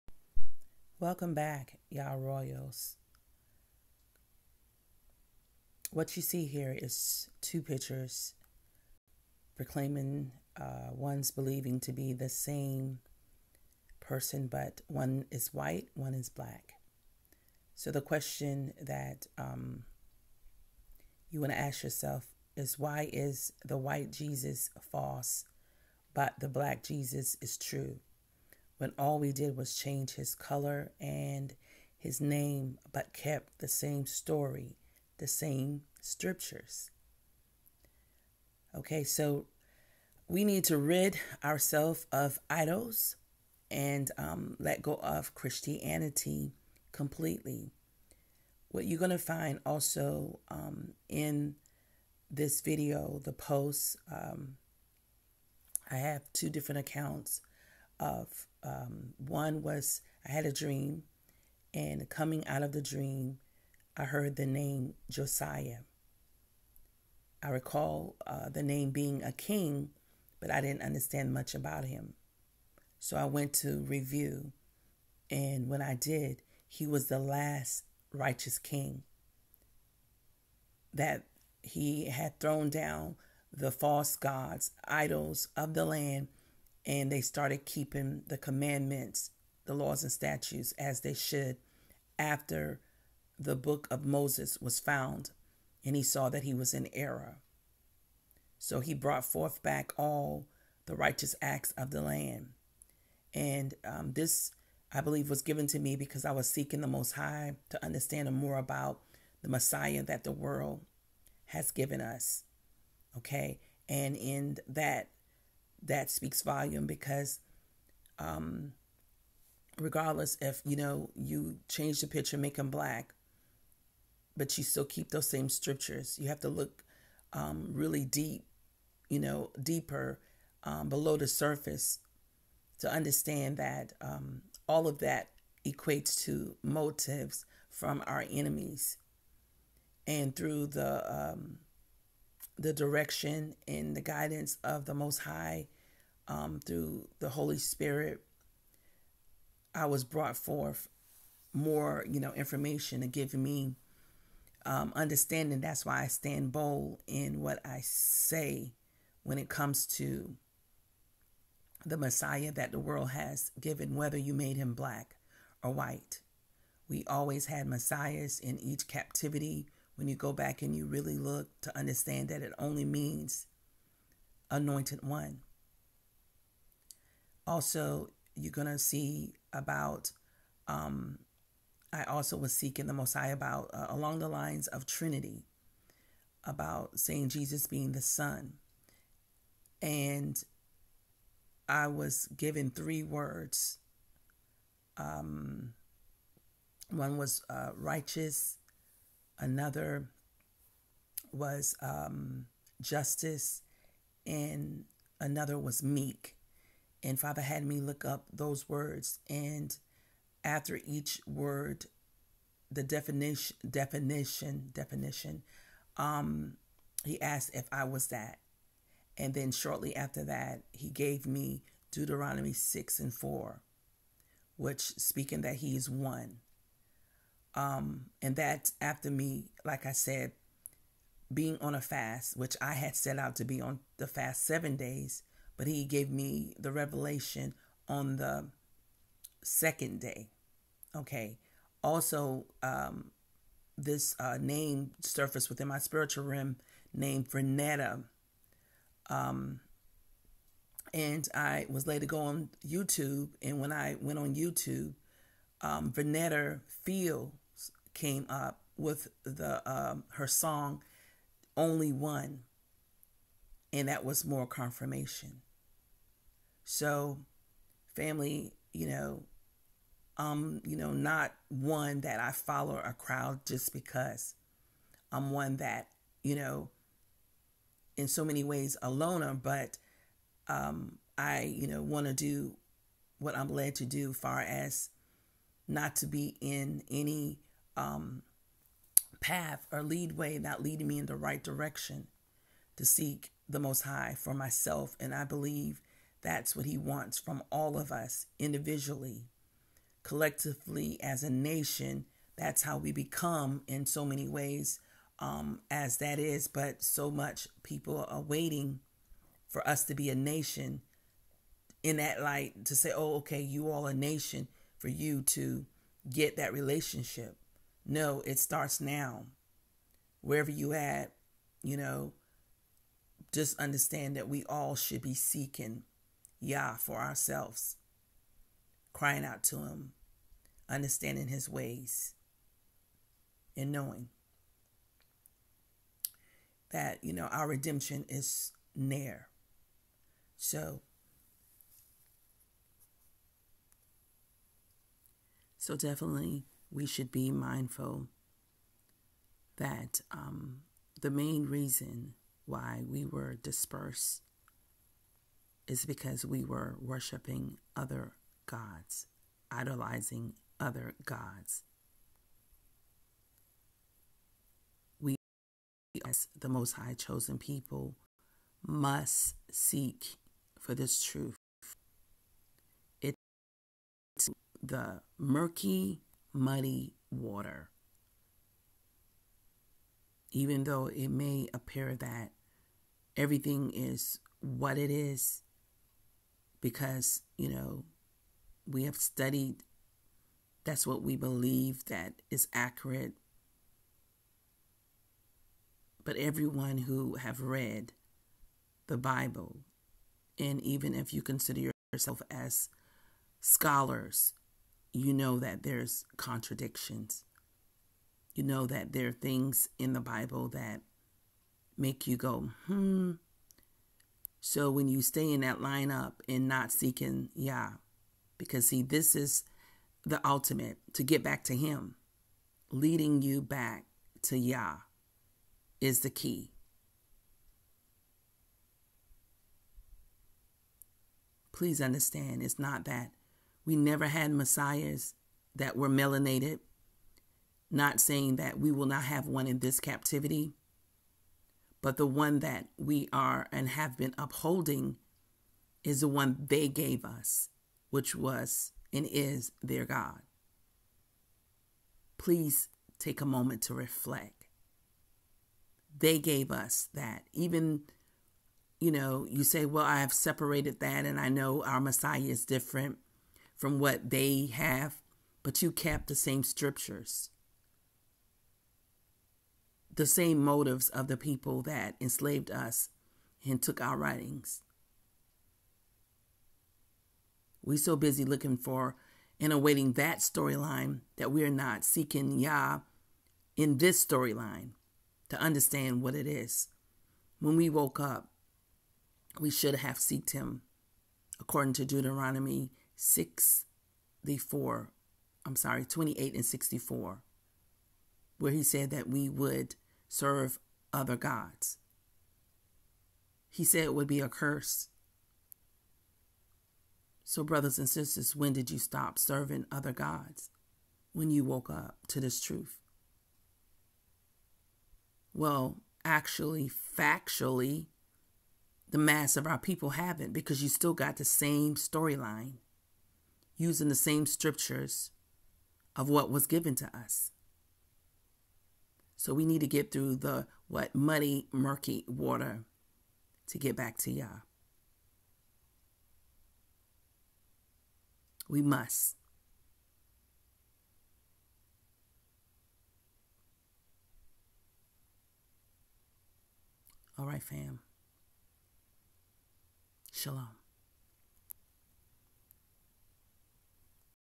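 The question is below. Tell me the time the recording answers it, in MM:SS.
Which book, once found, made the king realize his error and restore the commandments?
01:33.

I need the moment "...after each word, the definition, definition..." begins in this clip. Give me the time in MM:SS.
03:30.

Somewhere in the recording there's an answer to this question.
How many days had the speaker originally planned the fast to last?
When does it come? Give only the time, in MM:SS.
03:54.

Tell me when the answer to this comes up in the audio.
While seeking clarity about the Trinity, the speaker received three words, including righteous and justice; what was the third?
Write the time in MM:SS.
03:25.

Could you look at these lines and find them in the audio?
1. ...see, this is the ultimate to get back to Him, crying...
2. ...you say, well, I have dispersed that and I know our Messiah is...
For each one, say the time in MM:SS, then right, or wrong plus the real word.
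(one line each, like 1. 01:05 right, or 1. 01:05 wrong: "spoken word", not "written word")
1. 06:58 wrong: "leading", not "crying"
2. 07:39 wrong: "separated", not "dispersed".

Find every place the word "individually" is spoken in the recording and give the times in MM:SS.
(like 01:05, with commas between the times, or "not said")
04:58.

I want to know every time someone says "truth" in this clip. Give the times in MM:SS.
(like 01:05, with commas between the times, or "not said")
06:11, 08:32.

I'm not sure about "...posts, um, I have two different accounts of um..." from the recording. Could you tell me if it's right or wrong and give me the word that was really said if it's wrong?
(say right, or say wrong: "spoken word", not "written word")
right.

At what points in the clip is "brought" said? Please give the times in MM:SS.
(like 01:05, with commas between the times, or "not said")
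01:38, 02:30.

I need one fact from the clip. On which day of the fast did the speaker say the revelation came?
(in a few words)
The second day.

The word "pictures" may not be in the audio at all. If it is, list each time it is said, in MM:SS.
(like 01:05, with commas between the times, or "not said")
00:07, 02:02.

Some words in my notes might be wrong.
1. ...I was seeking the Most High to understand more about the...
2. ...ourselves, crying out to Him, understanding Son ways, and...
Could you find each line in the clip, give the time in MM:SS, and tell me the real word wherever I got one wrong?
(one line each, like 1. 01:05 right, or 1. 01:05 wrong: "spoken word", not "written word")
1. 01:46 right
2. 05:26 wrong: "His", not "Son".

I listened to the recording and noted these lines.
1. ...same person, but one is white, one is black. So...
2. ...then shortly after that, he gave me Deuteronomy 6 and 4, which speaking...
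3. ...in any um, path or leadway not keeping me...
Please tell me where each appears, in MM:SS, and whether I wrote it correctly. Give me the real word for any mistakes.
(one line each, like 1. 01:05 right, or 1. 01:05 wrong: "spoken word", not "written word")
1. 00:12 right
2. 03:39 right
3. 04:46 wrong: "leading", not "keeping".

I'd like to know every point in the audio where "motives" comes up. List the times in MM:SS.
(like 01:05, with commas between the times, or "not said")
02:16, 07:50.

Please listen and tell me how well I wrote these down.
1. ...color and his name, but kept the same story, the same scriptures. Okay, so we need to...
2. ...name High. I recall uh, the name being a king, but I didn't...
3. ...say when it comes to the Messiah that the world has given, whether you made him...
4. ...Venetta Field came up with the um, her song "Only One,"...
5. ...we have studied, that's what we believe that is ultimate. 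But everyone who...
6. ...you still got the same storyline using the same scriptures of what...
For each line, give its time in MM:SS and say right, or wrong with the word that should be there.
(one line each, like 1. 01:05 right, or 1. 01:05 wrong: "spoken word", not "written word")
1. 00:30 right
2. 01:04 wrong: "Josiah", not "High"
3. 02:37 right
4. 04:15 right
5. 06:28 wrong: "accurate", not "ultimate"
6. 08:40 right.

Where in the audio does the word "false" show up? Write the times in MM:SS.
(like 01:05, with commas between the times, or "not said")
00:24, 01:23.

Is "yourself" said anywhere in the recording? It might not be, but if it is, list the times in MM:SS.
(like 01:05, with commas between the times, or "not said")
00:21, 06:41.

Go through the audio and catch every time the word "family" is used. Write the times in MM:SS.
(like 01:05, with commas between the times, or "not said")
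04:27.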